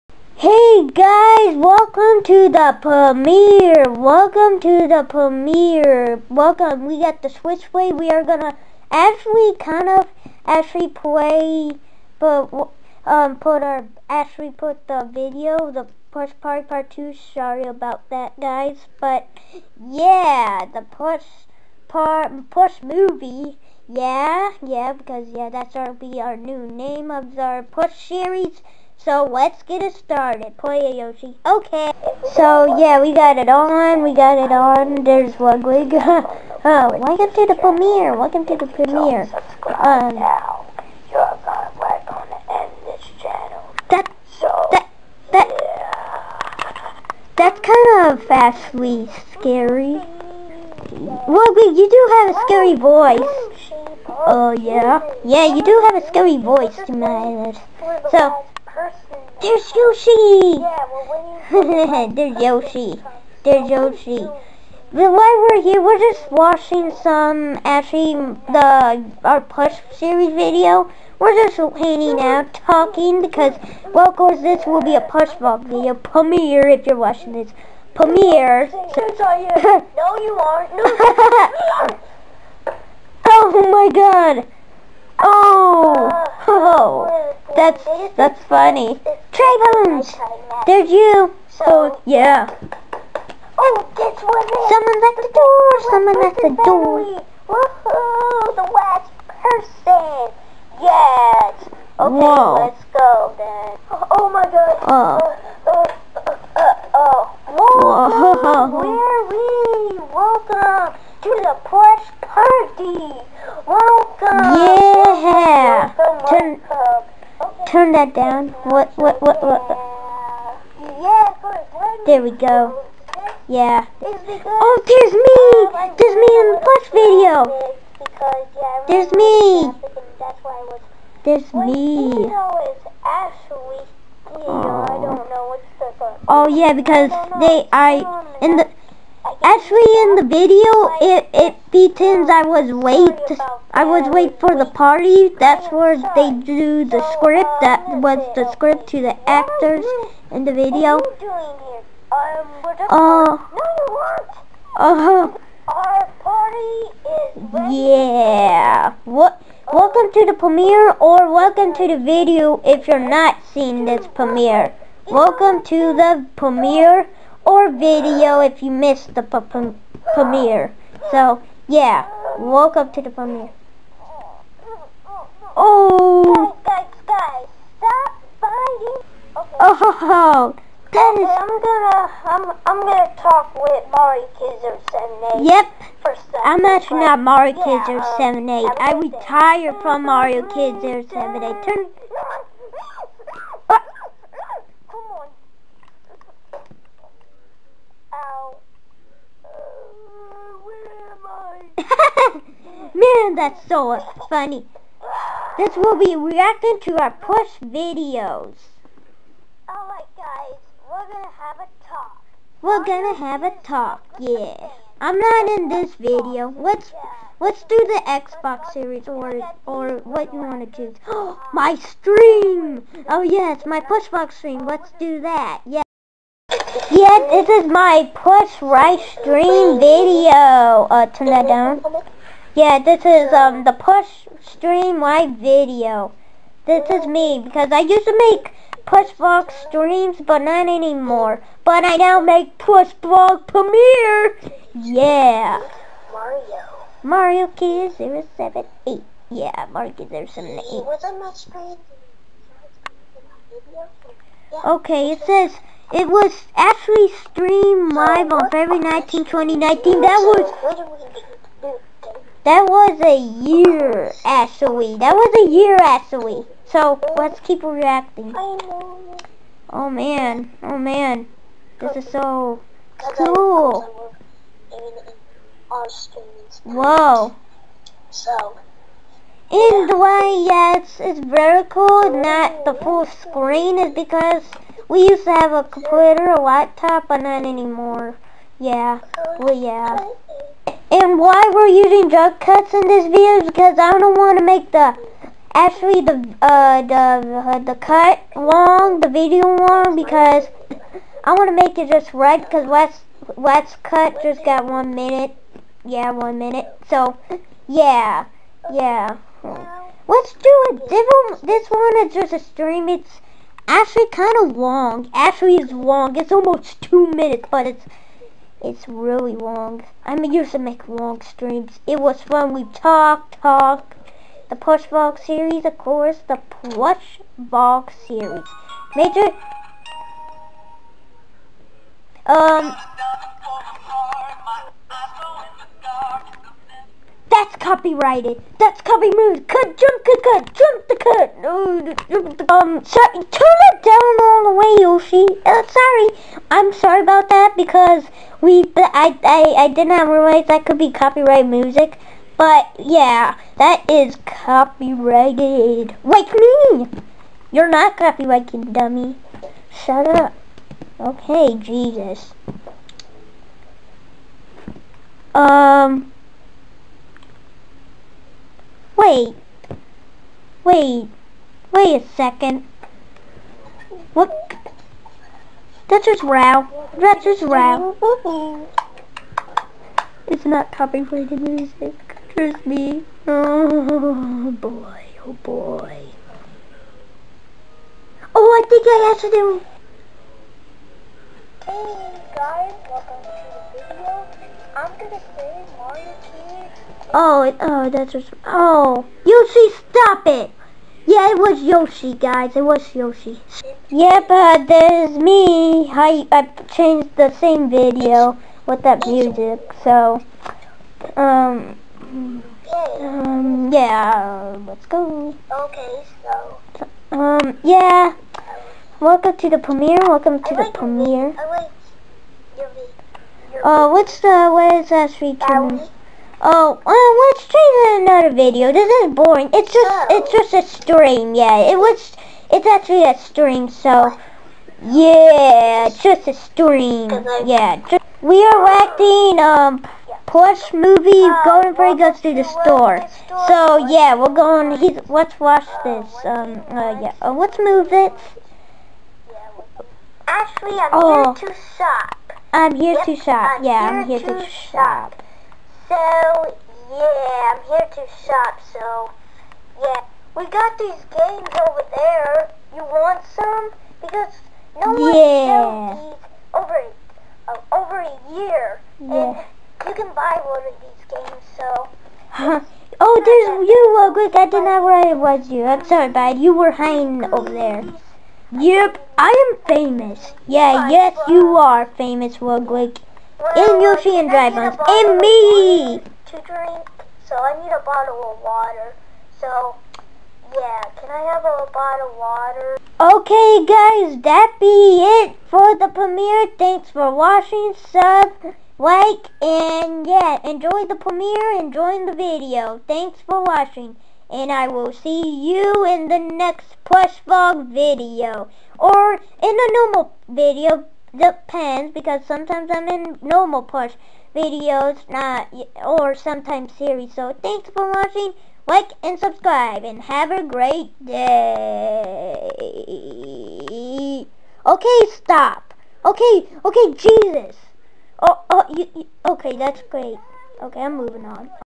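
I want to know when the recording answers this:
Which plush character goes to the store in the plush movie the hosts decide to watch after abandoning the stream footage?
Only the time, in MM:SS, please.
07:21.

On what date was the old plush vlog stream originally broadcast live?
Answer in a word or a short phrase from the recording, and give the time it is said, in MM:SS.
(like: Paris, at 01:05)
February 19, 2019, at 04:18.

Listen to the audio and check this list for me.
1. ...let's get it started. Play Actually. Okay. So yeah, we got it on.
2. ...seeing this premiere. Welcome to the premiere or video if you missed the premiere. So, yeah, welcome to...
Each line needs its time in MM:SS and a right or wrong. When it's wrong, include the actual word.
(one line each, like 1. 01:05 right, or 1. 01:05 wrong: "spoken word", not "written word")
1. 00:29 wrong: "Yoshi", not "Actually"
2. 02:43 right.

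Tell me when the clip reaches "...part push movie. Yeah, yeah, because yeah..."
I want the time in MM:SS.
00:21.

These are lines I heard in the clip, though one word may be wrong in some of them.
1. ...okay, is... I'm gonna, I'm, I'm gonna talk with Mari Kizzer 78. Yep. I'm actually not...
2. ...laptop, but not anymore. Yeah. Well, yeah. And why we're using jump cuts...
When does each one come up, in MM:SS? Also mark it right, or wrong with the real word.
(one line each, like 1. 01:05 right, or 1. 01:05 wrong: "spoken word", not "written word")
1. 03:01 right
2. 04:46 right.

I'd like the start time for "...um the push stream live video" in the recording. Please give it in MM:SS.
03:53.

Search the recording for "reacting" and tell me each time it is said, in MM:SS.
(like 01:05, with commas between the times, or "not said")
03:26, 04:27.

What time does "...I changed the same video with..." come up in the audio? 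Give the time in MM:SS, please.
06:46.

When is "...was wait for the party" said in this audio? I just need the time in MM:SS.
02:23.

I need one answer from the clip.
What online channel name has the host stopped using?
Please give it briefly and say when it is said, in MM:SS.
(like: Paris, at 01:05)
Mario Kids or 78, at 03:10.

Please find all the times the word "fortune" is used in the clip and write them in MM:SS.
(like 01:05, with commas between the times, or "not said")
not said.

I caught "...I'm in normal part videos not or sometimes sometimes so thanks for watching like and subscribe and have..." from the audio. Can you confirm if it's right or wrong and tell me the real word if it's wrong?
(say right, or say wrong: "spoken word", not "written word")
wrong: "series", not "sometimes".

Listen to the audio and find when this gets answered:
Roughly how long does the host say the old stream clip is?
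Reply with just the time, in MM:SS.
05:16.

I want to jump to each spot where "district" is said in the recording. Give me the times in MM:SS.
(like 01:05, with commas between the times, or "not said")
not said.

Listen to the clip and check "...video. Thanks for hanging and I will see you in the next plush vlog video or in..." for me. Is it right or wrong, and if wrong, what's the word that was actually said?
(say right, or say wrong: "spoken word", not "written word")
wrong: "watching", not "hanging".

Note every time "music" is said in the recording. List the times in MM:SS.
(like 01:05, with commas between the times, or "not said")
05:51, 06:21, 06:49.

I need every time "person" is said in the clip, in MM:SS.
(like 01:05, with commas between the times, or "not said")
01:39.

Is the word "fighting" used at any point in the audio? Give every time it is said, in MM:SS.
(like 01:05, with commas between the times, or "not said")
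02:58.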